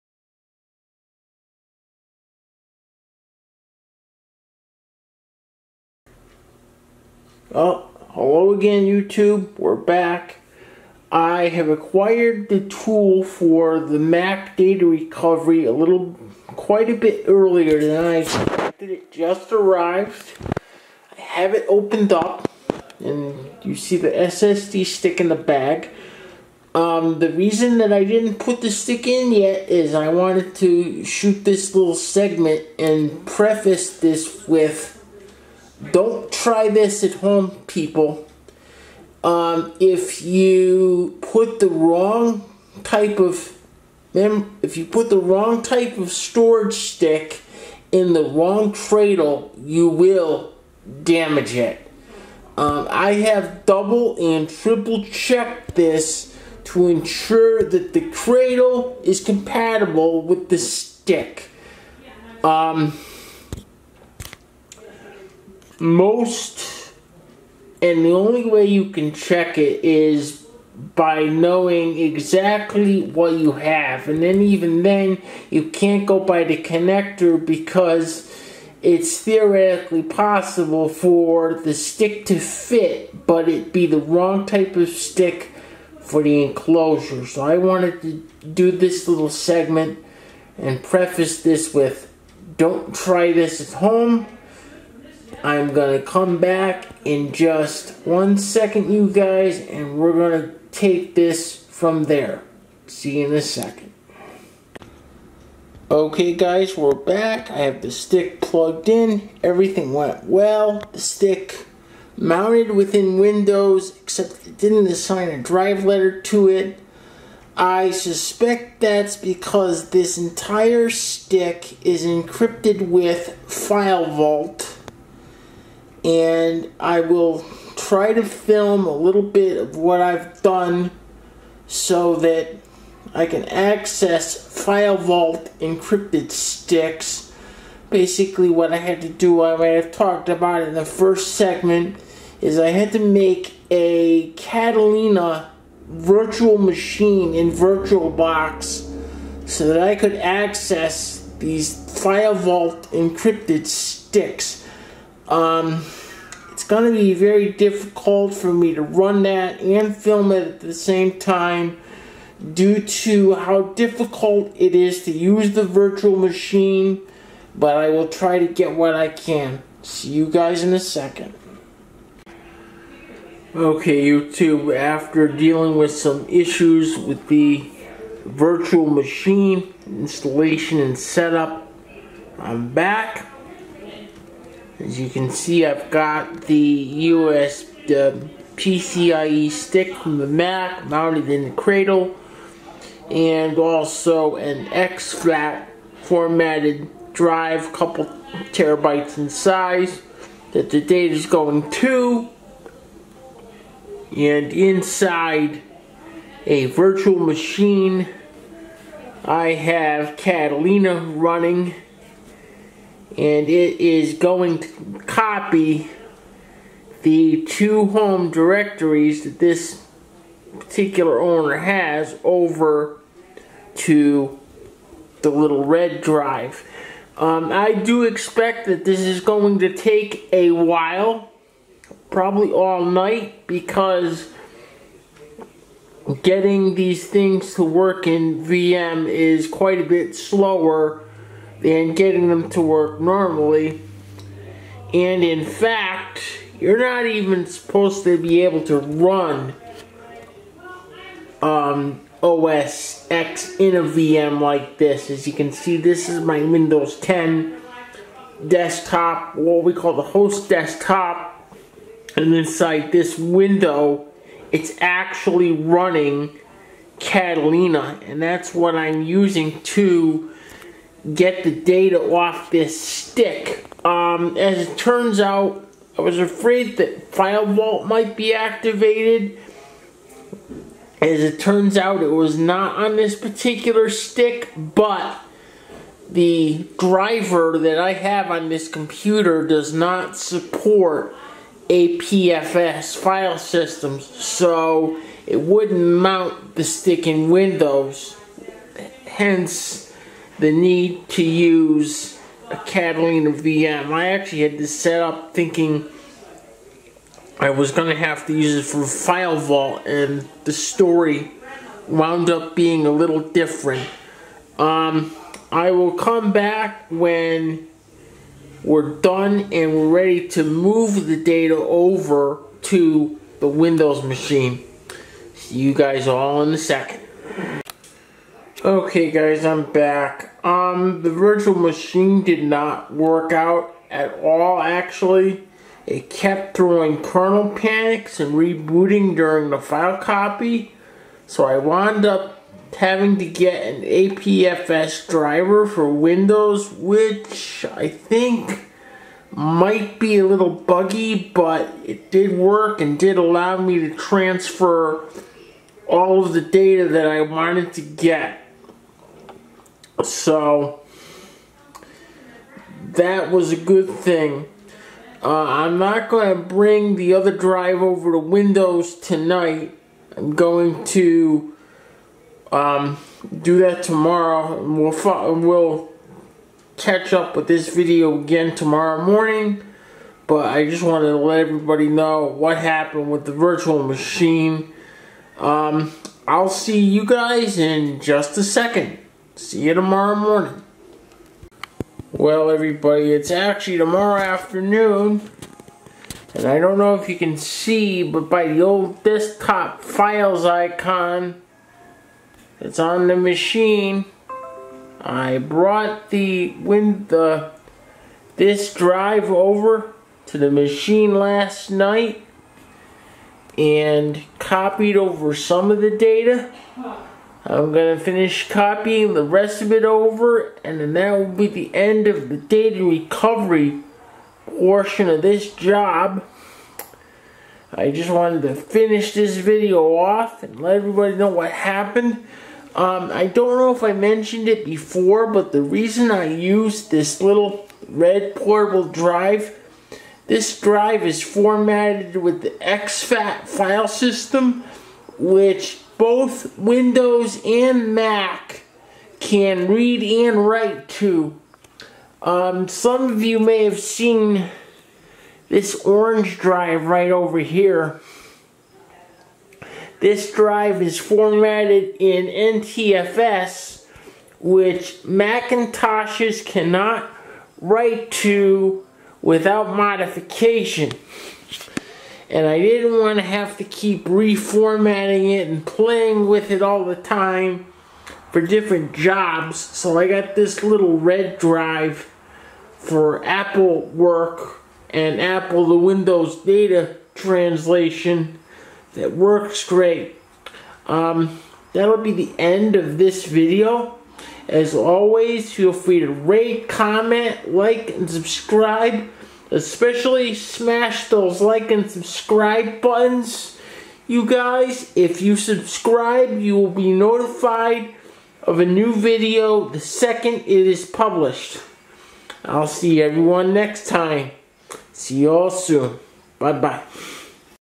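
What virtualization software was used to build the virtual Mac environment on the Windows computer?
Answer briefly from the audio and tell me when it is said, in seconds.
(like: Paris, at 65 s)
VirtualBox, at 147 s.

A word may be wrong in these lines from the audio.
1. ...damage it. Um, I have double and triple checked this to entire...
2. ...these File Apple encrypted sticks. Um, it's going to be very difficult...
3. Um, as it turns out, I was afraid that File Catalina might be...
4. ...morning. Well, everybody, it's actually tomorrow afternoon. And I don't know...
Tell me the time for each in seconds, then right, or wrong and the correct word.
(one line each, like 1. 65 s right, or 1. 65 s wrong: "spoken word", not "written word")
1. 51 s wrong: "ensure", not "entire"
2. 151 s wrong: "Vault", not "Apple"
3. 273 s wrong: "Vault", not "Catalina"
4. 390 s right.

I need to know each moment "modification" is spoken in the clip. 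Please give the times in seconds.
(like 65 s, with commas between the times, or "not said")
469 s.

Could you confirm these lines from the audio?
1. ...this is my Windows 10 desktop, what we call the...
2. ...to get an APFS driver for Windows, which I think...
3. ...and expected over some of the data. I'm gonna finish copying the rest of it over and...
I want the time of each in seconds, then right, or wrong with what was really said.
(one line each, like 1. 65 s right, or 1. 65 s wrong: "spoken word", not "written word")
1. 255 s right
2. 343 s right
3. 413 s wrong: "copied", not "expected".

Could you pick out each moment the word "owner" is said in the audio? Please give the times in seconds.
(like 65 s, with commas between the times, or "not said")
221 s.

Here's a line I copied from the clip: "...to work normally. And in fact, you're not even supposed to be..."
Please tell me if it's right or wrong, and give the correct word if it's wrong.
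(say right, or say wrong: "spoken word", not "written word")
right.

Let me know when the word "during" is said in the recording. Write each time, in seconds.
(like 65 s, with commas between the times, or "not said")
339 s.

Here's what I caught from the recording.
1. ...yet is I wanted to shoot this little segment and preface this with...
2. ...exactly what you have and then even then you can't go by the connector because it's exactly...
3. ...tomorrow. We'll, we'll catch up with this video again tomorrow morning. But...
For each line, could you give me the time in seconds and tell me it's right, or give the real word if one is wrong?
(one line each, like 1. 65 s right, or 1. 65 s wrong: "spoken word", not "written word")
1. 29 s right
2. 71 s wrong: "theoretically", not "exactly"
3. 373 s right.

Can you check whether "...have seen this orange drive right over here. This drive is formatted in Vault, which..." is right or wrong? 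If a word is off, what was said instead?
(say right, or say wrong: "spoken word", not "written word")
wrong: "NTFS", not "Vault".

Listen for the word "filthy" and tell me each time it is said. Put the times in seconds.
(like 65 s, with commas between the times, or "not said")
not said.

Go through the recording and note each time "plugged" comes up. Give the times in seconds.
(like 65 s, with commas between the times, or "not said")
108 s.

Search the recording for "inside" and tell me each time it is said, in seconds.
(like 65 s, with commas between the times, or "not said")
204 s, 262 s.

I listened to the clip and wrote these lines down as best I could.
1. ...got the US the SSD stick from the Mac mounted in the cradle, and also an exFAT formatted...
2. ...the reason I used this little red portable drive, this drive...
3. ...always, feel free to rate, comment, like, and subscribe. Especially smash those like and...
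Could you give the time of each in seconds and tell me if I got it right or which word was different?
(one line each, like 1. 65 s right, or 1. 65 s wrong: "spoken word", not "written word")
1. 185 s wrong: "PCIe", not "SSD"
2. 435 s right
3. 494 s right.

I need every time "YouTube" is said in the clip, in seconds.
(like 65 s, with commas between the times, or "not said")
8 s, 174 s.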